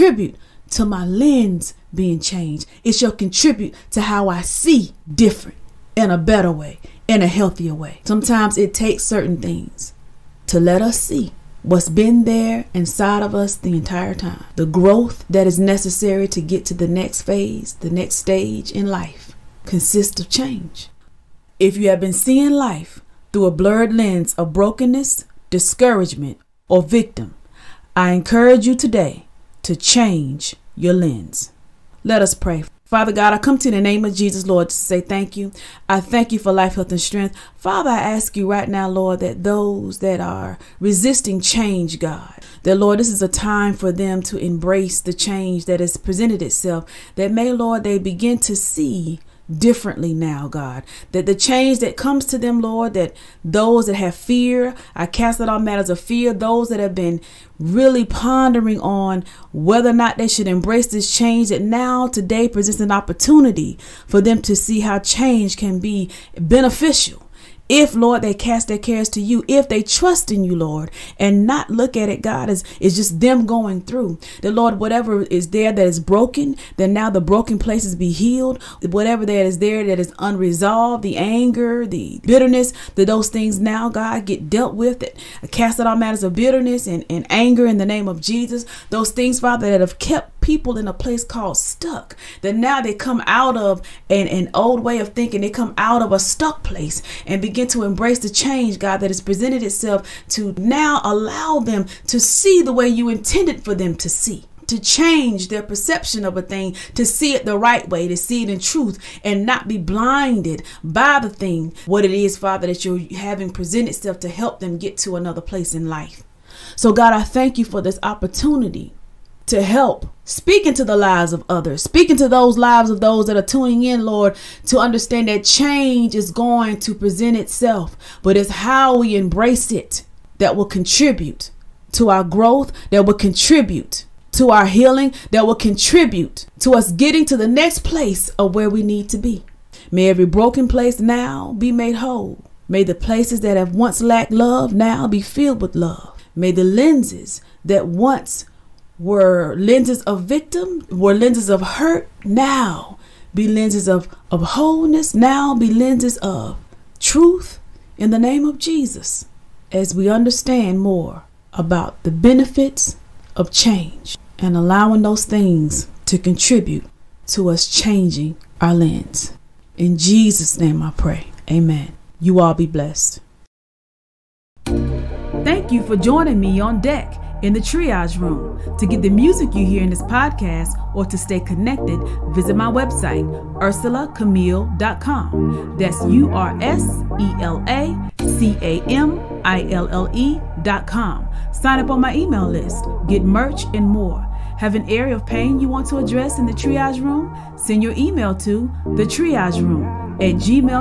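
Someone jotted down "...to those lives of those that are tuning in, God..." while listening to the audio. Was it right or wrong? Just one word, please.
wrong.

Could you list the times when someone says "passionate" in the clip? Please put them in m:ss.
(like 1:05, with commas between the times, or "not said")
not said.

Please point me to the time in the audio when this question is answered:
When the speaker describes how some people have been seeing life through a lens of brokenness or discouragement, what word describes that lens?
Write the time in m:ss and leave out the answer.
0:23.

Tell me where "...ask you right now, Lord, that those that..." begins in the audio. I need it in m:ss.
0:37.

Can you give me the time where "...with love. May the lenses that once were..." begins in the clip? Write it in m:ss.
2:25.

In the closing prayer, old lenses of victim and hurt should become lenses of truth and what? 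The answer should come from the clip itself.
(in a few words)
wholeness.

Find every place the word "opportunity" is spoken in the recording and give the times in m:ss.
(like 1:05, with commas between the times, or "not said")
1:02, 1:58.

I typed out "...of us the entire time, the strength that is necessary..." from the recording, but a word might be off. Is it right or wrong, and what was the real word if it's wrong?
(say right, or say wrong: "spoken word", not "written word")
wrong: "growth", not "strength".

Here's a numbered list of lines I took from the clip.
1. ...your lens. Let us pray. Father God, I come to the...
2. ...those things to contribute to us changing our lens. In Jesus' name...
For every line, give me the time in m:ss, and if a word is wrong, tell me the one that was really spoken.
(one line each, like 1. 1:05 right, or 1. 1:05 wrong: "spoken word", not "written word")
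1. 0:30 right
2. 2:45 right.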